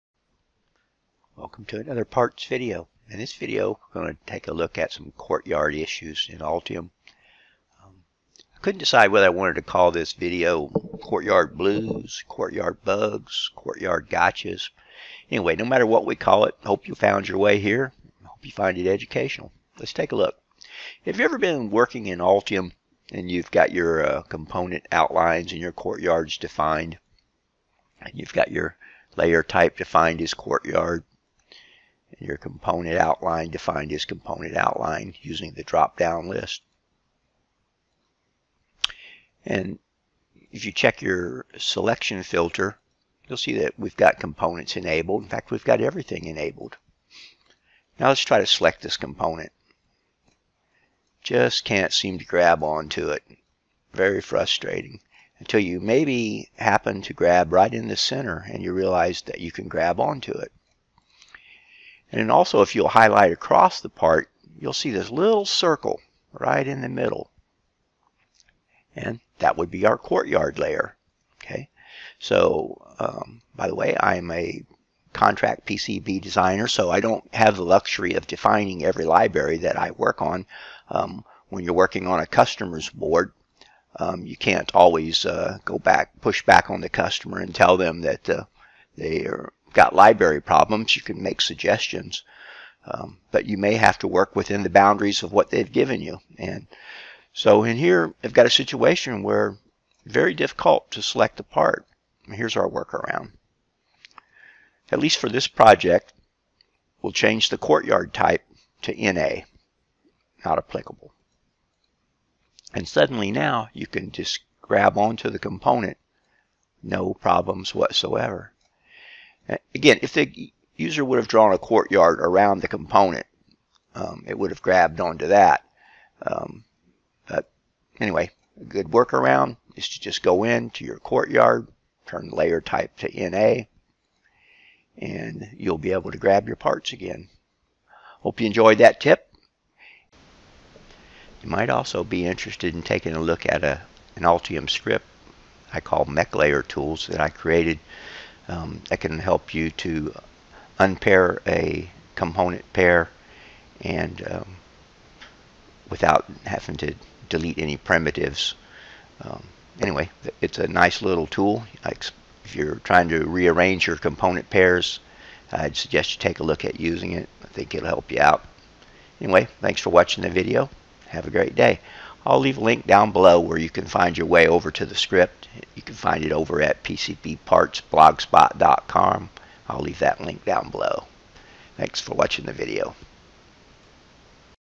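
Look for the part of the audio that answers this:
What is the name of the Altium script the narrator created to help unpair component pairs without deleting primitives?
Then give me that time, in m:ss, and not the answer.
2:26.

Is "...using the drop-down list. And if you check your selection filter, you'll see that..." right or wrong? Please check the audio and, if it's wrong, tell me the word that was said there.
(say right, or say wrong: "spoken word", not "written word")
right.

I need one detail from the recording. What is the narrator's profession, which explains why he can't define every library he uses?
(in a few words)
contract PCB designer.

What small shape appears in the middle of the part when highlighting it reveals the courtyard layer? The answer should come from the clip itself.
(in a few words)
little circle.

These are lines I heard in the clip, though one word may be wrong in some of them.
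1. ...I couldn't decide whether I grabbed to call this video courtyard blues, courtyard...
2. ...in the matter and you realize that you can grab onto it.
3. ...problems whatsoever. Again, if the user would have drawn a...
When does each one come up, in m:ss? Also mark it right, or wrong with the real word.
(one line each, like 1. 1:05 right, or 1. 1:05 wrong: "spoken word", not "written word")
1. 0:08 wrong: "wanted", not "grabbed"
2. 0:57 wrong: "center", not "matter"
3. 1:57 right.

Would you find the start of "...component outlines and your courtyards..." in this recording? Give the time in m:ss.
0:24.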